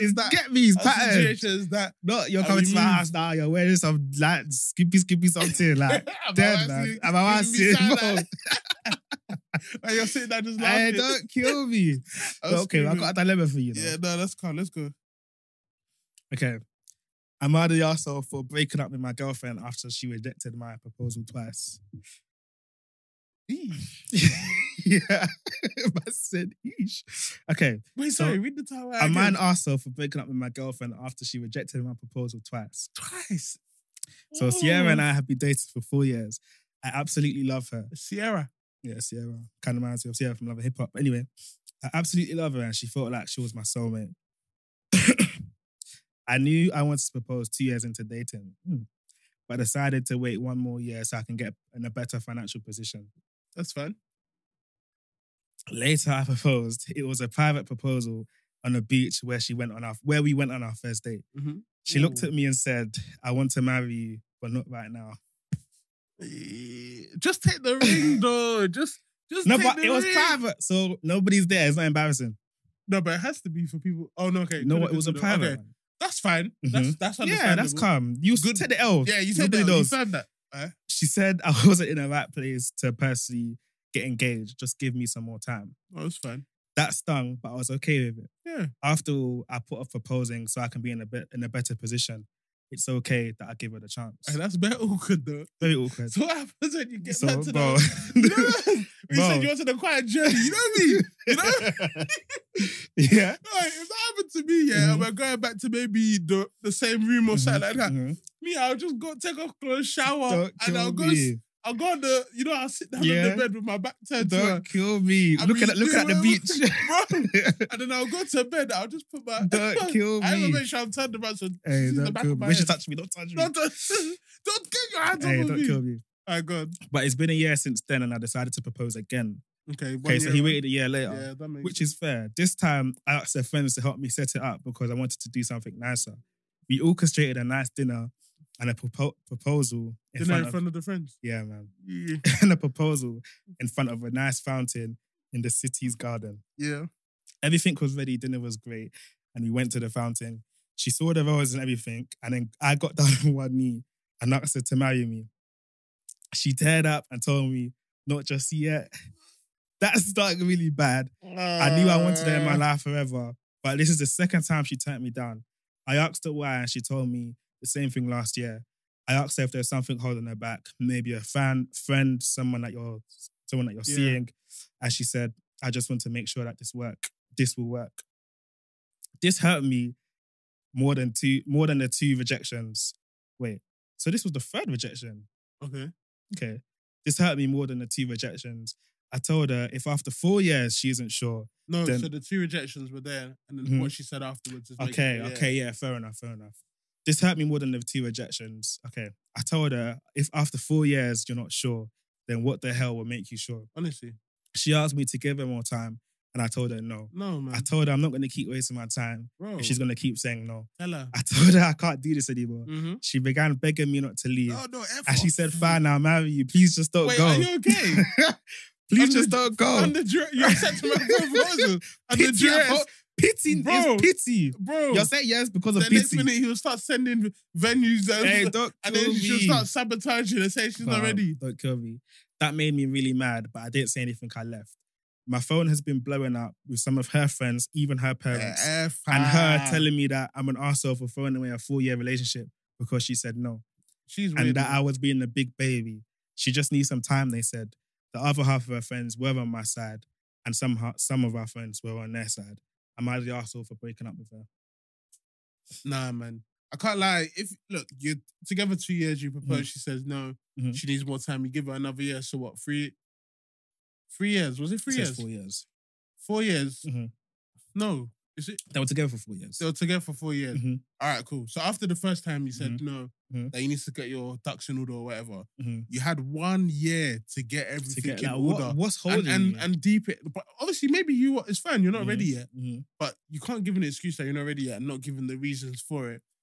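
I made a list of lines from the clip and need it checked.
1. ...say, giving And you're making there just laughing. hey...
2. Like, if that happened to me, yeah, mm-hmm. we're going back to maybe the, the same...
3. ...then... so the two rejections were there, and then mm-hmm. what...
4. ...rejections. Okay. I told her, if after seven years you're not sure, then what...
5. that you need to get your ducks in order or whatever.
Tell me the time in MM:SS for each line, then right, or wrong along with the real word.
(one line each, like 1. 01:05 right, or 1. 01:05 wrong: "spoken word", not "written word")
1. 00:07 wrong: "sitting", not "making"
2. 01:43 right
3. 03:11 right
4. 03:18 wrong: "four", not "seven"
5. 04:33 right.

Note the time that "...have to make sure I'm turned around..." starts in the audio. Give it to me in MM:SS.
02:00.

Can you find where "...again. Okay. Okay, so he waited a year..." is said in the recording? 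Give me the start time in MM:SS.
02:08.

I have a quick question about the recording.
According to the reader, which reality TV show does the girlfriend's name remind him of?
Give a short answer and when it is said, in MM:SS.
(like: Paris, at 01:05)
Love of Hip Hop, at 00:40.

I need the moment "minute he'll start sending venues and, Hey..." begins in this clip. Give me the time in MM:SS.
03:46.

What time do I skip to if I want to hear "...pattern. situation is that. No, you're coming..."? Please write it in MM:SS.
00:00.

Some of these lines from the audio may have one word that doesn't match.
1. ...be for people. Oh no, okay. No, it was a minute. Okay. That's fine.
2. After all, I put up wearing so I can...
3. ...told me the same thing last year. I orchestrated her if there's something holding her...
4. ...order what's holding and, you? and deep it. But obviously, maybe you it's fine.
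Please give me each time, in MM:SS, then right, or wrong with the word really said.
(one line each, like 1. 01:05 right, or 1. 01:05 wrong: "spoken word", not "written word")
1. 01:13 wrong: "private", not "minute"
2. 01:28 wrong: "proposing", not "wearing"
3. 02:46 wrong: "asked", not "orchestrated"
4. 04:38 right.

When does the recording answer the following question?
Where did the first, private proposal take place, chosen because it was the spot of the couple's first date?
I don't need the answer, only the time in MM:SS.
00:58.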